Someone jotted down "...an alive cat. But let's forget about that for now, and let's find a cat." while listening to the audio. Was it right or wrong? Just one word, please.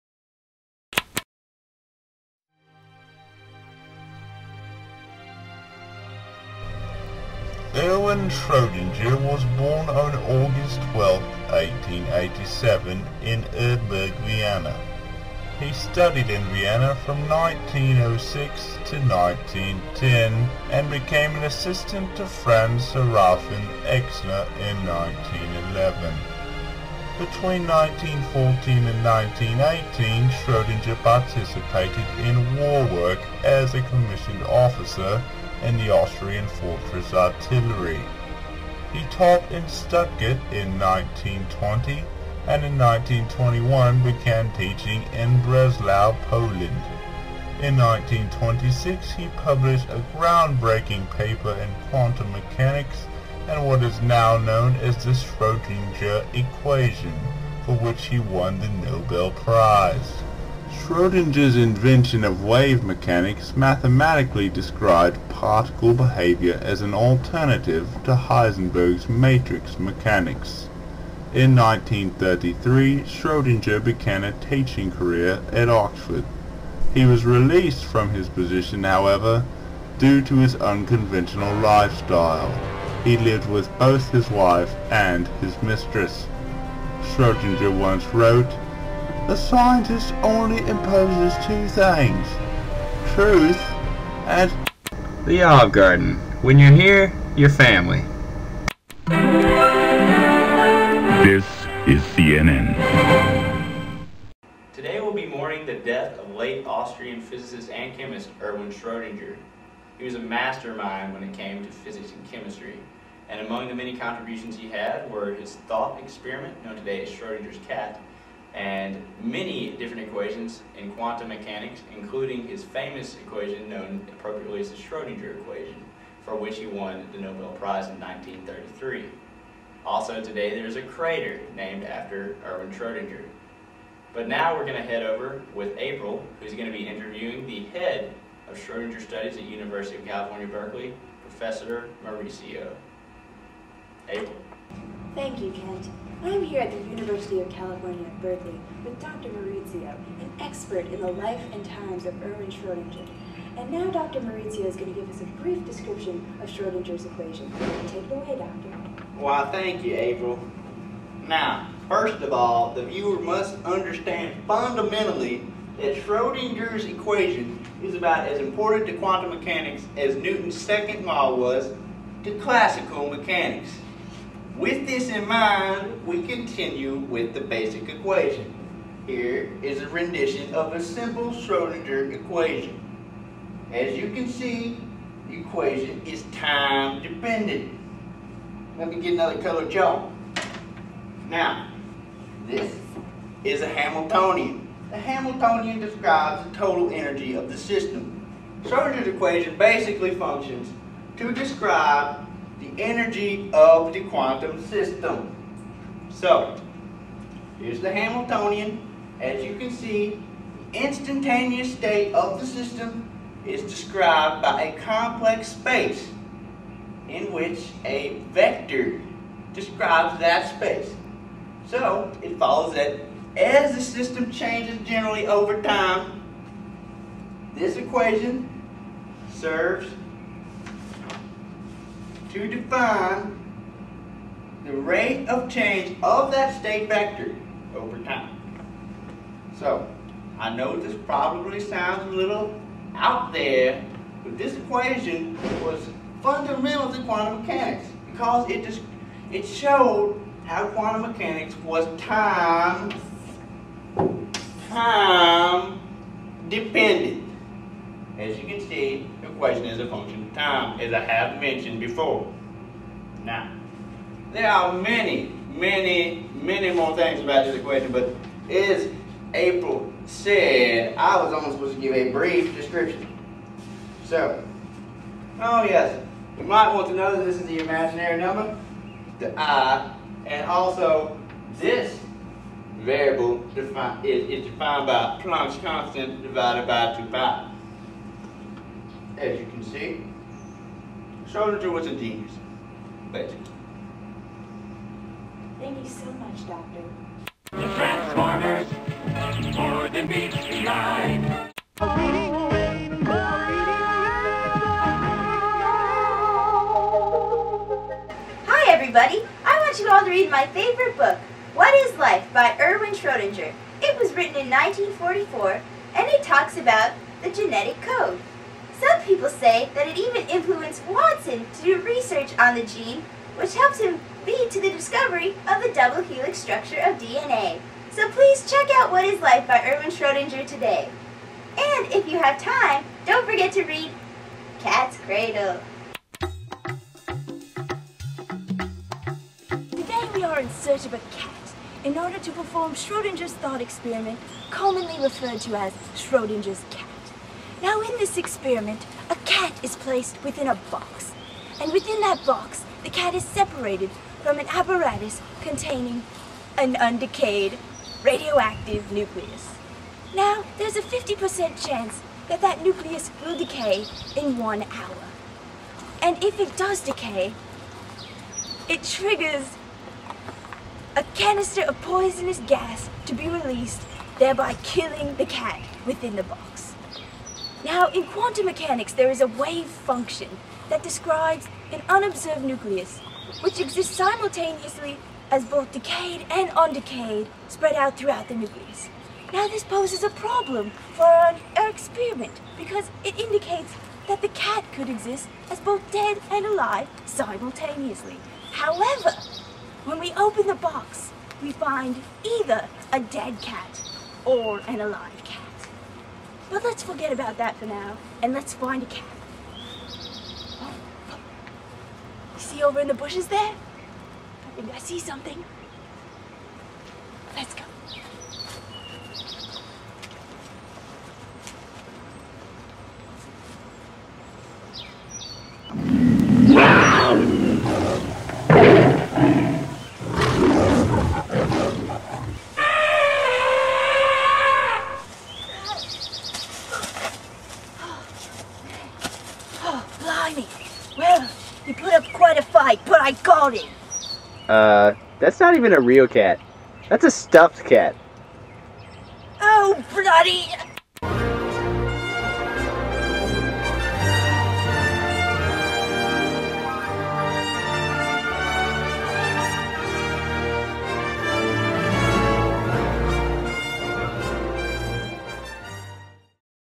right.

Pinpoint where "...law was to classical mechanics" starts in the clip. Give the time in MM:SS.
02:51.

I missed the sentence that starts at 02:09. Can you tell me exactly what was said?
Also today there's a crater named after Erwin Schrodinger.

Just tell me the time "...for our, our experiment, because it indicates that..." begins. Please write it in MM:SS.
06:30.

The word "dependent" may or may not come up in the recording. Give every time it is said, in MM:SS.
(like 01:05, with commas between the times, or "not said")
03:07, 04:16.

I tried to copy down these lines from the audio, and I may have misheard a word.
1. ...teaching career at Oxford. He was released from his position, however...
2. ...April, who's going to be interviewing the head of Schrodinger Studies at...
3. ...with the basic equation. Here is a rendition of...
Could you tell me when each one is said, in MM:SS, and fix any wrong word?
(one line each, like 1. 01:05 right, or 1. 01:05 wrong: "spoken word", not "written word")
1. 01:14 right
2. 02:15 right
3. 02:56 right.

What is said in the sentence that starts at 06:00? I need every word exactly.
Now, there's a 50% chance that that nucleus will decay in one hour.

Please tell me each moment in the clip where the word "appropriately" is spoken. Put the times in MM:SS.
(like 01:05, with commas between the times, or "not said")
02:04.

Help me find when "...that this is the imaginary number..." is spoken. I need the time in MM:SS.
04:37.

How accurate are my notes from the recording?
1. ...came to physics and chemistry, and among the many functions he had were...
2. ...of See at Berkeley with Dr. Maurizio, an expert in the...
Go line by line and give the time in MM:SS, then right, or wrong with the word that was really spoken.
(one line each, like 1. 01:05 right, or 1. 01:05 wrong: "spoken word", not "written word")
1. 01:51 wrong: "contributions", not "functions"
2. 02:27 wrong: "California", not "See".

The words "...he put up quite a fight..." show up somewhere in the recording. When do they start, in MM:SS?
07:21.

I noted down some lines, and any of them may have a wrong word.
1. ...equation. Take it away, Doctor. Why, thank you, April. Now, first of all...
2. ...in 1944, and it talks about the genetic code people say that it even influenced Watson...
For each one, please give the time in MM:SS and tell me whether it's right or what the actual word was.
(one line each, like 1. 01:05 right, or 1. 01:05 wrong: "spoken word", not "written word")
1. 02:37 right
2. 05:14 right.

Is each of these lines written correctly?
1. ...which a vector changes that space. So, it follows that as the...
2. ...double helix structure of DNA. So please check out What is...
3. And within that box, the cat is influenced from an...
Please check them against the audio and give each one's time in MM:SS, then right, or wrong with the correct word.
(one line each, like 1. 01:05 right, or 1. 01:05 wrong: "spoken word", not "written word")
1. 03:37 wrong: "describes", not "changes"
2. 05:25 right
3. 05:51 wrong: "separated", not "influenced".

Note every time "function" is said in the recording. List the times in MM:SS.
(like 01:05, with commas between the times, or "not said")
03:20, 04:19, 06:19.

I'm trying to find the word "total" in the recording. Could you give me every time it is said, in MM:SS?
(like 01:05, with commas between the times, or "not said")
03:16.